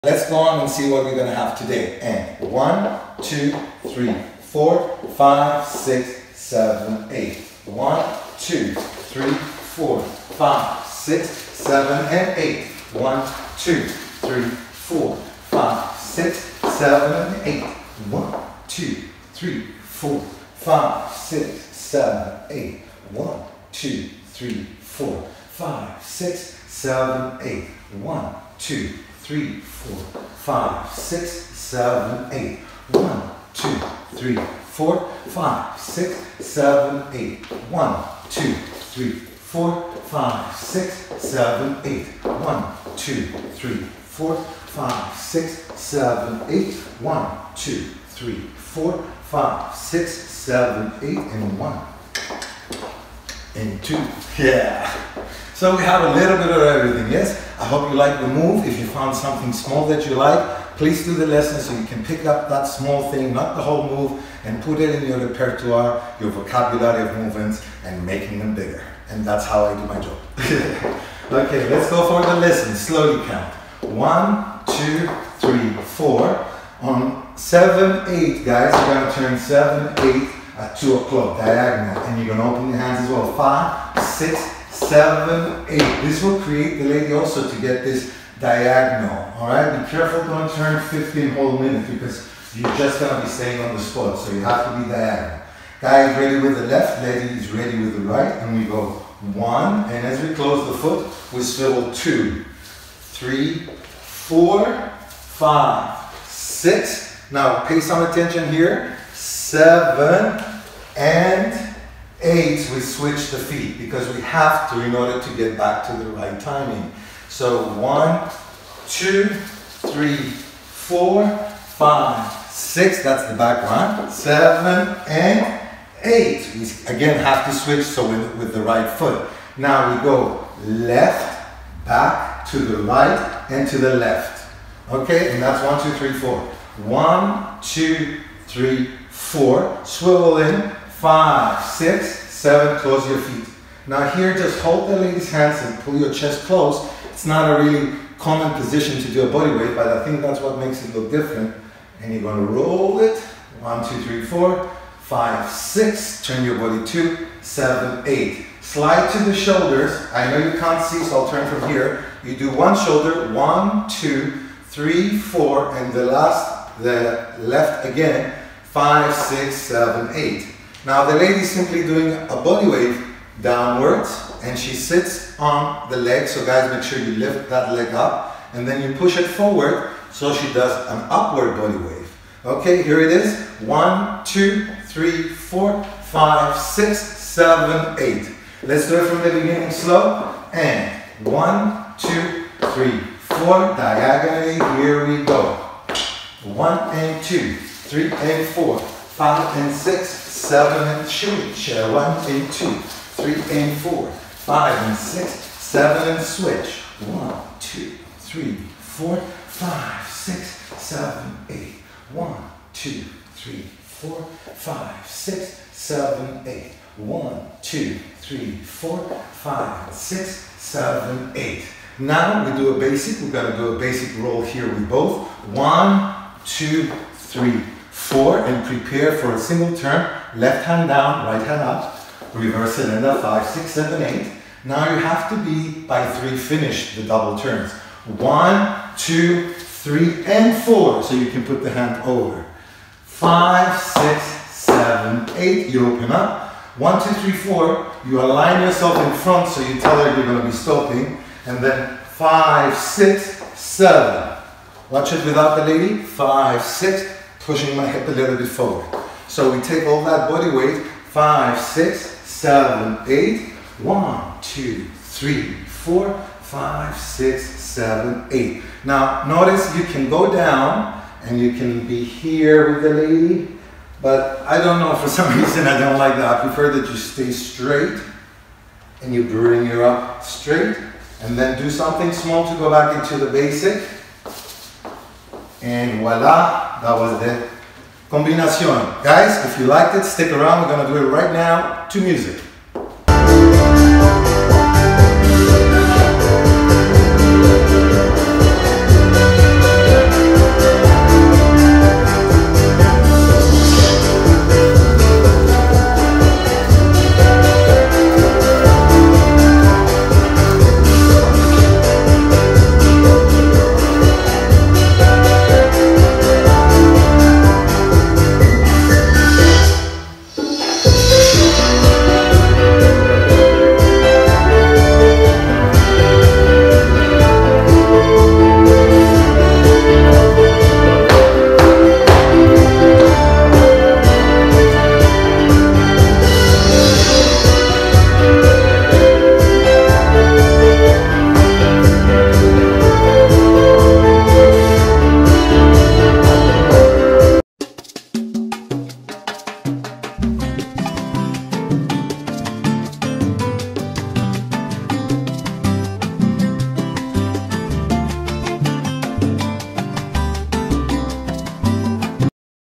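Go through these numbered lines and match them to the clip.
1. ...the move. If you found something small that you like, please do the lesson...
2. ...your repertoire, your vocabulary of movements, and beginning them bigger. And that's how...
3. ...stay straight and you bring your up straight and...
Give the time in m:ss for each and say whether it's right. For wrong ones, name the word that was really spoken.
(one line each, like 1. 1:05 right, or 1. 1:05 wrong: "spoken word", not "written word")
1. 0:58 right
2. 1:05 wrong: "making", not "beginning"
3. 4:36 right.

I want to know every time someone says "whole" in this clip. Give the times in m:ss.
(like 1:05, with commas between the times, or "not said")
1:03, 1:31.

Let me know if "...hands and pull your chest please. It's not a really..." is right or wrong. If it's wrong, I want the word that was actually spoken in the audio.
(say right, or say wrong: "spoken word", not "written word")
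wrong: "close", not "please".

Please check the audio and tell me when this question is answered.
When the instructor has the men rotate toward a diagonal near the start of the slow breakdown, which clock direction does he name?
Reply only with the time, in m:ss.
1:20.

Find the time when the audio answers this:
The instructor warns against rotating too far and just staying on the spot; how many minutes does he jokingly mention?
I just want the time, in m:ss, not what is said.
1:30.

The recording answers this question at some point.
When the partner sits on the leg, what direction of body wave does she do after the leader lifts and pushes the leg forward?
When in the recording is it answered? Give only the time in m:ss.
3:01.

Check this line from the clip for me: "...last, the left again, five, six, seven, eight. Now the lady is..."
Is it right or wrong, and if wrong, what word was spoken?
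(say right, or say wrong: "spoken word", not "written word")
right.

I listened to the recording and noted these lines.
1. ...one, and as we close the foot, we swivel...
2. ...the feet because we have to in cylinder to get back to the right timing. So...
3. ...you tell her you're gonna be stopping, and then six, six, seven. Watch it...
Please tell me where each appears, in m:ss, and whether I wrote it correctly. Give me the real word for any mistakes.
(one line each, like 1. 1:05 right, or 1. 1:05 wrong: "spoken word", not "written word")
1. 1:39 right
2. 1:53 wrong: "order", not "cylinder"
3. 4:09 wrong: "five", not "six".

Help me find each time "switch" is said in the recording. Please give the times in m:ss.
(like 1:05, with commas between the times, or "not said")
1:52, 2:07.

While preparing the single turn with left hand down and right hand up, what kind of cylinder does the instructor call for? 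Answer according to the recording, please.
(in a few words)
reverse cylinder.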